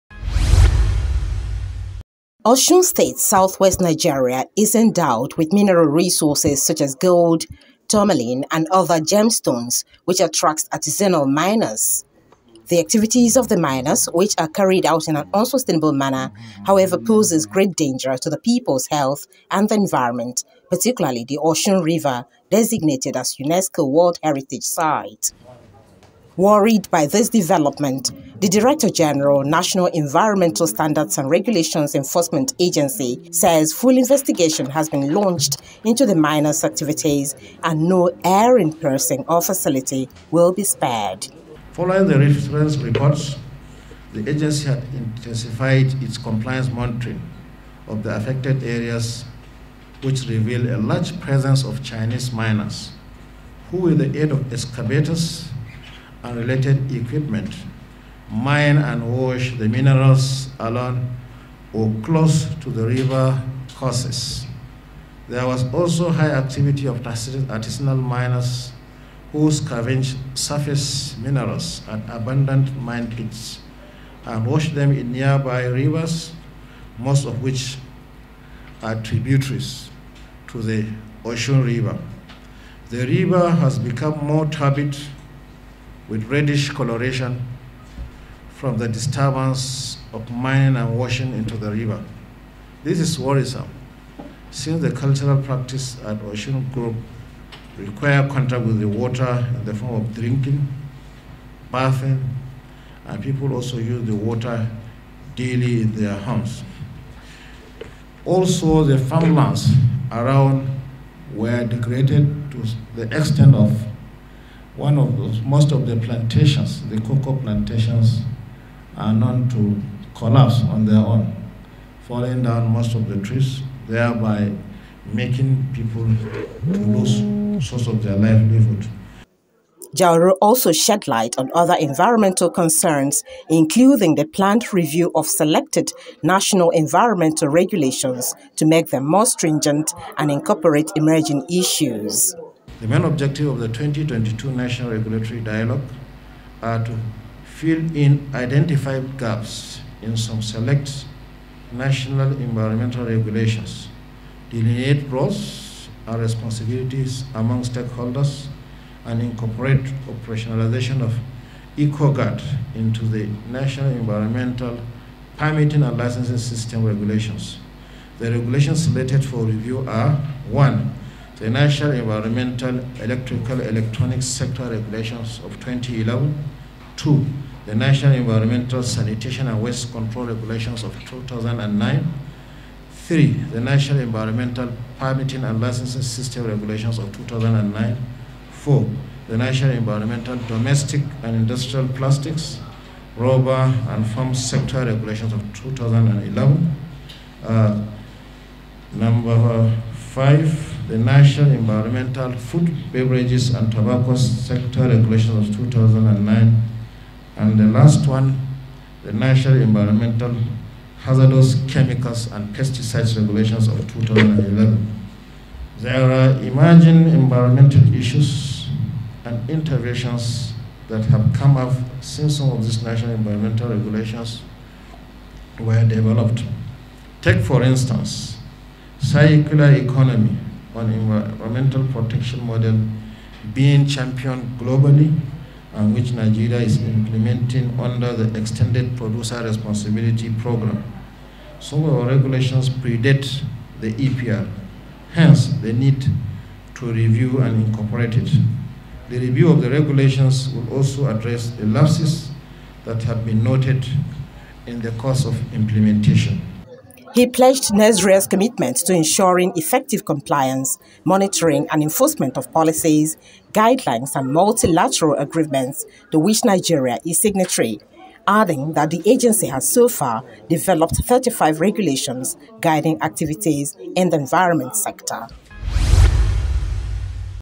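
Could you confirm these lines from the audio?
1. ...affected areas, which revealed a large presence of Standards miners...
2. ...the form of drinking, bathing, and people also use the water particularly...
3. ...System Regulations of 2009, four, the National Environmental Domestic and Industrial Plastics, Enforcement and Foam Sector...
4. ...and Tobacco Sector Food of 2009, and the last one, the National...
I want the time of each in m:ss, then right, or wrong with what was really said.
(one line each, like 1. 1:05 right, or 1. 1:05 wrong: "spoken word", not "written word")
1. 0:48 wrong: "Chinese", not "Standards"
2. 1:39 wrong: "daily", not "particularly"
3. 3:06 wrong: "Rubber", not "Enforcement"
4. 3:23 wrong: "Regulations", not "Food".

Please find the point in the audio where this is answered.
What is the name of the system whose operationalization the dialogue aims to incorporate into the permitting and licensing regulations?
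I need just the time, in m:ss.
2:41.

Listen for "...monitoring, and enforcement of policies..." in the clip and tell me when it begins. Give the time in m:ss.
4:21.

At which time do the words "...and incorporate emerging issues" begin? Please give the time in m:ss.
2:20.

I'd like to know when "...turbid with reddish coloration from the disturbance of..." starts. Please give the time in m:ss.
1:24.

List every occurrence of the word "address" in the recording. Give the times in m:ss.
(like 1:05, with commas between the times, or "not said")
4:11.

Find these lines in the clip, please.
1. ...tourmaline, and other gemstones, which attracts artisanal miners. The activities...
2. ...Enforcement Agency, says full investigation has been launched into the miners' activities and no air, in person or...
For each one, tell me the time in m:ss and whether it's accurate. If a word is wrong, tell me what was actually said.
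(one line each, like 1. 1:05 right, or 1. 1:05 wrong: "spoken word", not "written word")
1. 0:07 right
2. 0:31 right.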